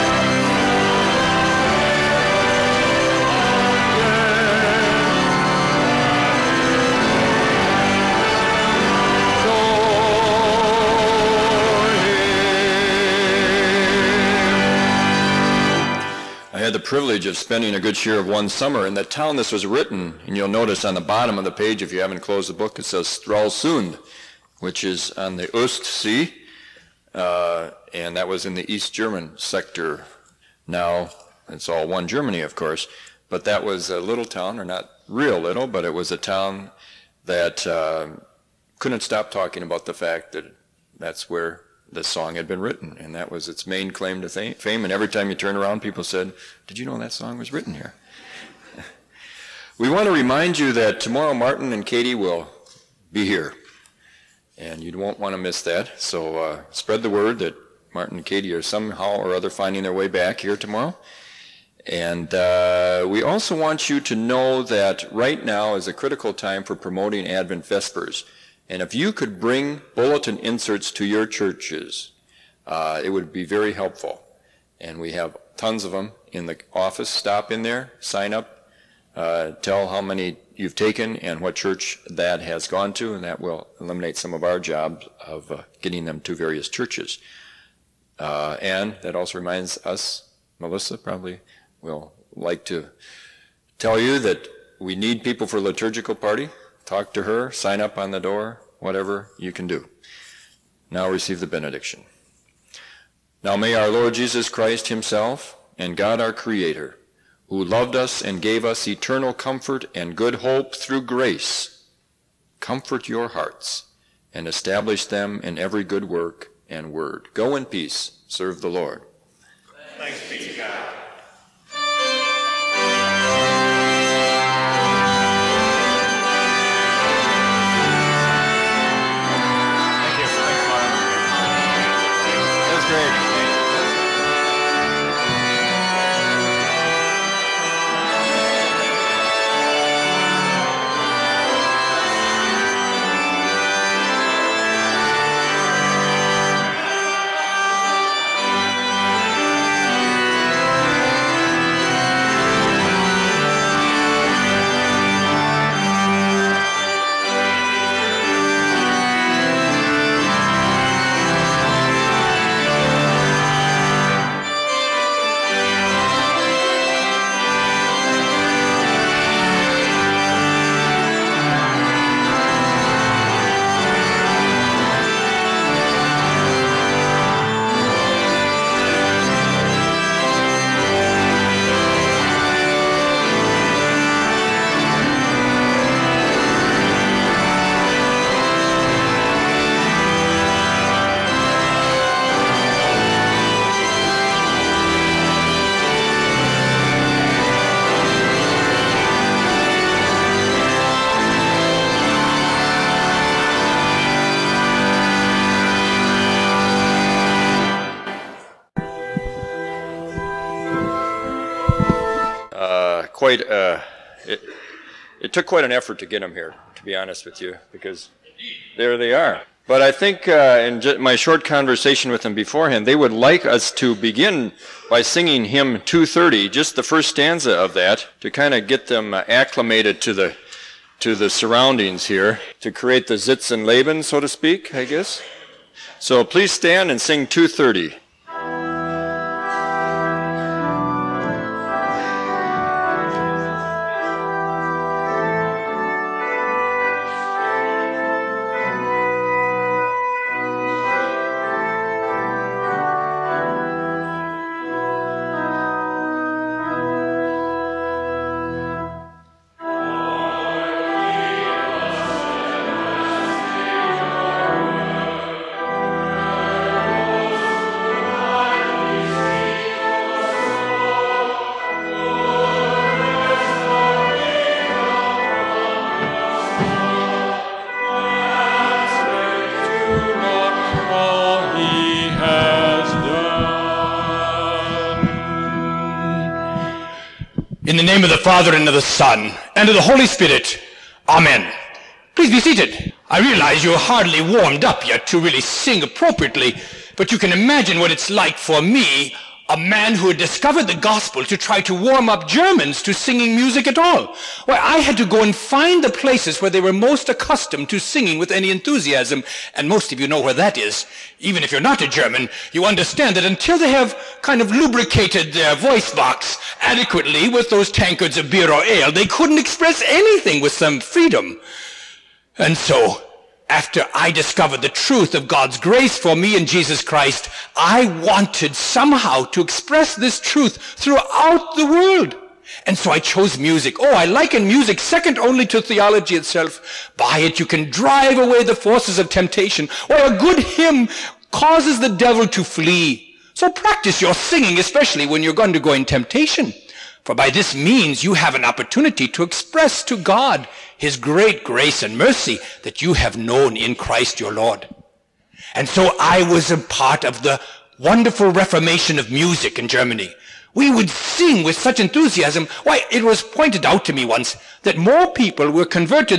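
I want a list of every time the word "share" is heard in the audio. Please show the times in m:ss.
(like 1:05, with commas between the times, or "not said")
0:17.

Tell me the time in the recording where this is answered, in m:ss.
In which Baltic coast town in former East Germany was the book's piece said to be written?
0:23.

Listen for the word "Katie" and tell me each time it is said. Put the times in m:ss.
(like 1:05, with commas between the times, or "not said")
0:51, 0:58.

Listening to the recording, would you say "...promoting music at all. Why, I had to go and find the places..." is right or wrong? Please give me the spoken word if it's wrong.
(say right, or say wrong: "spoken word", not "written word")
wrong: "singing", not "promoting".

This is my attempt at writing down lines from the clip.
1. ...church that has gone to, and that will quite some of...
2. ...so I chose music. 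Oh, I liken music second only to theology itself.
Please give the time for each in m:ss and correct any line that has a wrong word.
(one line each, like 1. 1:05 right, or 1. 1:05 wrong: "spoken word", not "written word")
1. 1:21 wrong: "eliminate", not "quite"
2. 5:32 right.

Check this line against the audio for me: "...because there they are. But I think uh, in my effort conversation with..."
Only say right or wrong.
wrong.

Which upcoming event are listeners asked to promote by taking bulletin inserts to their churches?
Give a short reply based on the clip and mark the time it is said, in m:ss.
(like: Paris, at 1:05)
Advent Vespers, at 1:07.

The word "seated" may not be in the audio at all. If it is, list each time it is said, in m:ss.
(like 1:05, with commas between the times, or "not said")
4:52.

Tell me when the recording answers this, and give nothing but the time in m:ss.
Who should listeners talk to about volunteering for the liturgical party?
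1:30.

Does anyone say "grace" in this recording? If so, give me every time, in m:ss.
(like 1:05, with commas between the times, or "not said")
1:51, 5:25, 5:51.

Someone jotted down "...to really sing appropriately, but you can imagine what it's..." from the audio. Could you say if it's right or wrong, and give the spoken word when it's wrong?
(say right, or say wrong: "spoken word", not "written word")
right.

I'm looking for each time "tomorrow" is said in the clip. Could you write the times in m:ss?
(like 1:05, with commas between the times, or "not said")
0:50, 1:00.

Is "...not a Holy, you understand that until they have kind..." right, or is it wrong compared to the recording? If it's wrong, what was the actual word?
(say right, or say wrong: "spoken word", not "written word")
wrong: "German", not "Holy".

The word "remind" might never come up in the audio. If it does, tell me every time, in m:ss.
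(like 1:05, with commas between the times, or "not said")
0:50, 1:29.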